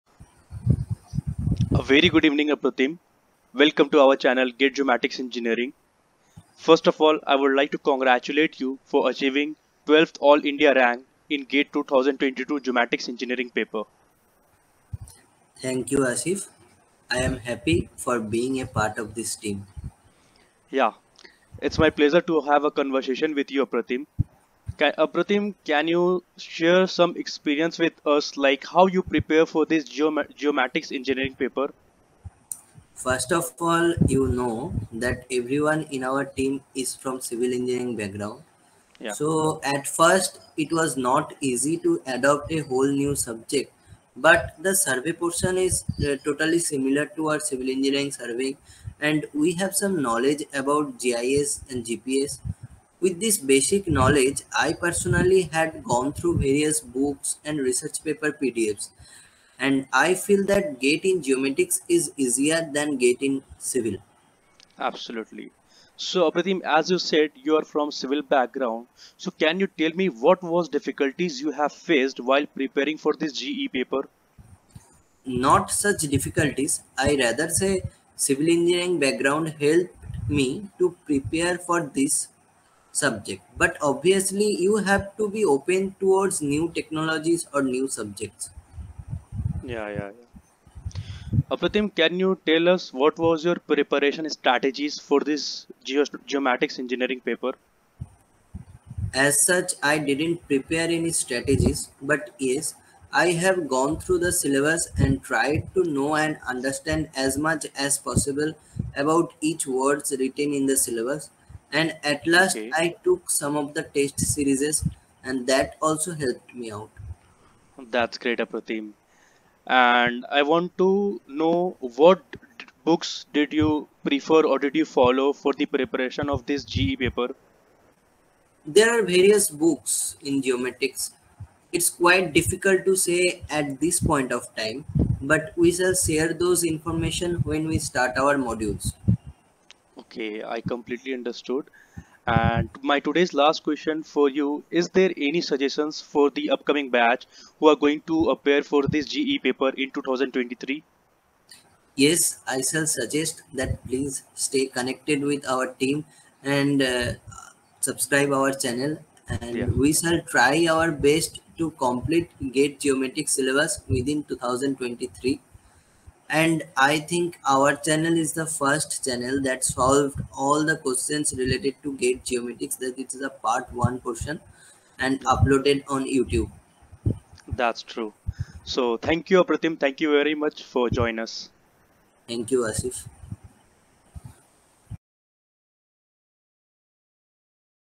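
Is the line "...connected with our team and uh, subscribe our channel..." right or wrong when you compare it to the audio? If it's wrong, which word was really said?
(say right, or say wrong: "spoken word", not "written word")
right.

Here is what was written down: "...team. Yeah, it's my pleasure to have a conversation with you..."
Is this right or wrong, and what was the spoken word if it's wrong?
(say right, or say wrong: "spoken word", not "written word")
right.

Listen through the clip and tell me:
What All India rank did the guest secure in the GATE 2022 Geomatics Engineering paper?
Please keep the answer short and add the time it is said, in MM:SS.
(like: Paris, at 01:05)
12th, at 00:09.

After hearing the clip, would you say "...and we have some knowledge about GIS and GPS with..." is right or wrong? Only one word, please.
right.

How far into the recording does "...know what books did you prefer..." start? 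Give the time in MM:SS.
02:01.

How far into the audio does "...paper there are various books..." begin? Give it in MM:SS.
02:07.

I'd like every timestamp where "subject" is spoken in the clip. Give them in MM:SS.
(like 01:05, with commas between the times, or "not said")
00:43, 01:22, 01:27.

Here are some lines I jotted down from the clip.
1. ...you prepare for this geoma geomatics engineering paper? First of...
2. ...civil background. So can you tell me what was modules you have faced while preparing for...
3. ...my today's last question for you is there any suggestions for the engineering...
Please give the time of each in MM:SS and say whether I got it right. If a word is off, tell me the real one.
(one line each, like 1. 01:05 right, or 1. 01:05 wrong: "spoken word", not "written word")
1. 00:28 right
2. 01:07 wrong: "difficulties", not "modules"
3. 02:22 wrong: "upcoming", not "engineering".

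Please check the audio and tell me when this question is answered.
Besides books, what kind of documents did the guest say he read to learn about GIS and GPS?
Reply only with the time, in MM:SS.
00:57.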